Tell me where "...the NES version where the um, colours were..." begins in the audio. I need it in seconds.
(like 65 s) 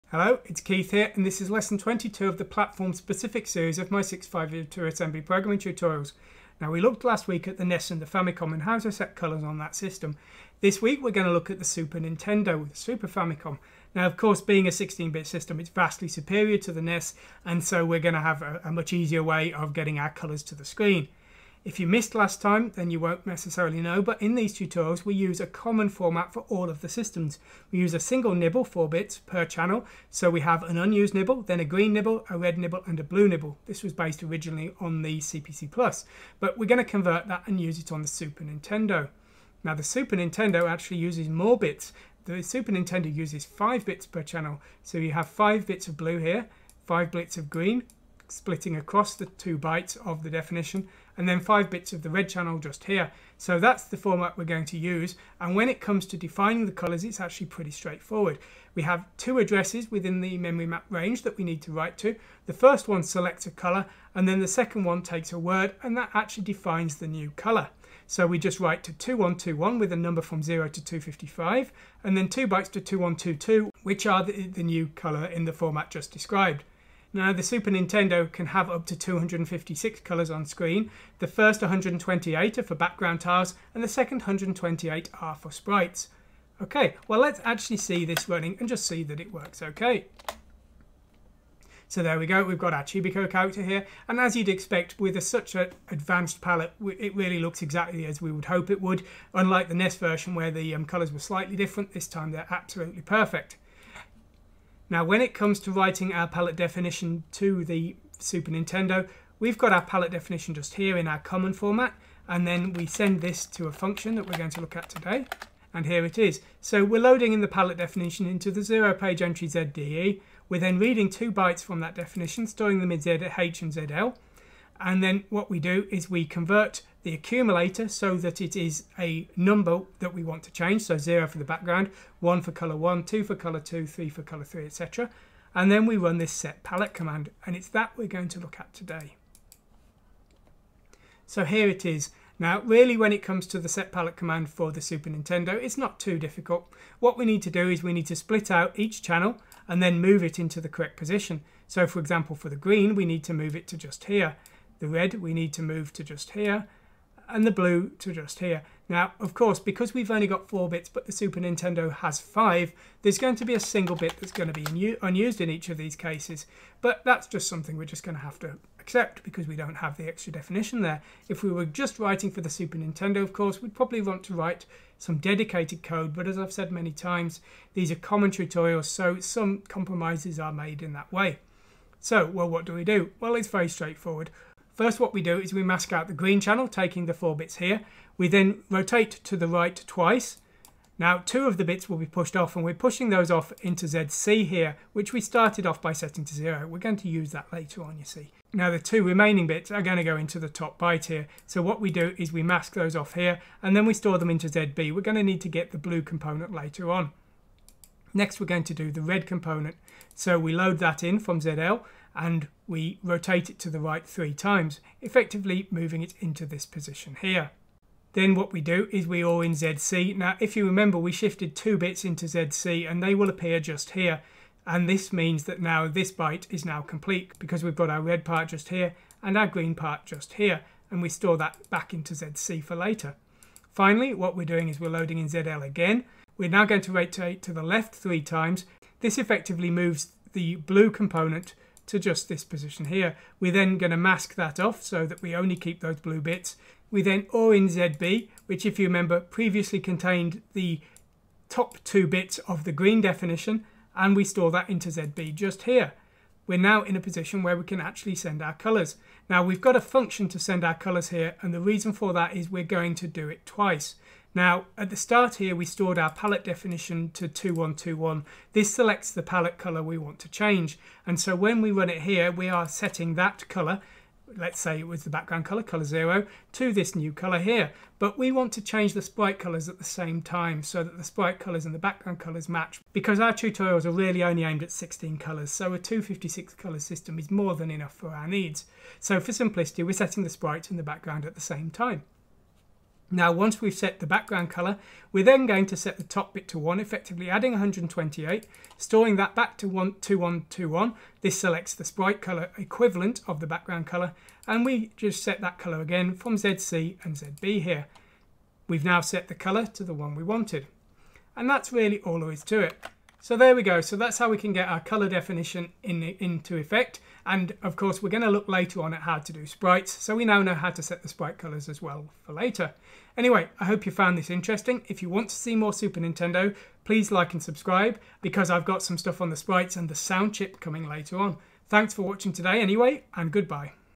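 99 s.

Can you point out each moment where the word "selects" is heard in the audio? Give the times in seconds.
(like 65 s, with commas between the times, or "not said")
63 s, 268 s, 301 s.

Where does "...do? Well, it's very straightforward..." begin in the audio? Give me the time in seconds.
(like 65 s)
182 s.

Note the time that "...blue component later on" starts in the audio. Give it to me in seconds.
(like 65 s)
205 s.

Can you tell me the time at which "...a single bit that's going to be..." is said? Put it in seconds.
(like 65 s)
163 s.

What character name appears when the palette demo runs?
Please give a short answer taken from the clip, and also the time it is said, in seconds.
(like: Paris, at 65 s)
Chibiko, at 92 s.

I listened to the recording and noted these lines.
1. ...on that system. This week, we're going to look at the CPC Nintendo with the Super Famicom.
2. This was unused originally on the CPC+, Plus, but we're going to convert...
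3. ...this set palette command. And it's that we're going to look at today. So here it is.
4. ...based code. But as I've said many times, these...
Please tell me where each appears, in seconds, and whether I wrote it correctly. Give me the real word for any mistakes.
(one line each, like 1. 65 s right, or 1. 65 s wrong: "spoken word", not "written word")
1. 9 s wrong: "Super", not "CPC"
2. 33 s wrong: "based", not "unused"
3. 136 s right
4. 175 s wrong: "dedicated", not "based".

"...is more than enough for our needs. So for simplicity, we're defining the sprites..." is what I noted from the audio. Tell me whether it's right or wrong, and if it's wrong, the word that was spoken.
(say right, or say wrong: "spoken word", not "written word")
wrong: "setting", not "defining".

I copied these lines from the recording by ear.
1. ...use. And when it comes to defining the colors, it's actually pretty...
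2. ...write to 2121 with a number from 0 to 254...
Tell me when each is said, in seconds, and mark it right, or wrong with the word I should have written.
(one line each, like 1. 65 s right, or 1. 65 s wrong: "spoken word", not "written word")
1. 54 s right
2. 68 s wrong: "255", not "254".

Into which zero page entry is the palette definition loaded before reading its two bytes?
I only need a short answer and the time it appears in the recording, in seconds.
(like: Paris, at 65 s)
ZDE, at 119 s.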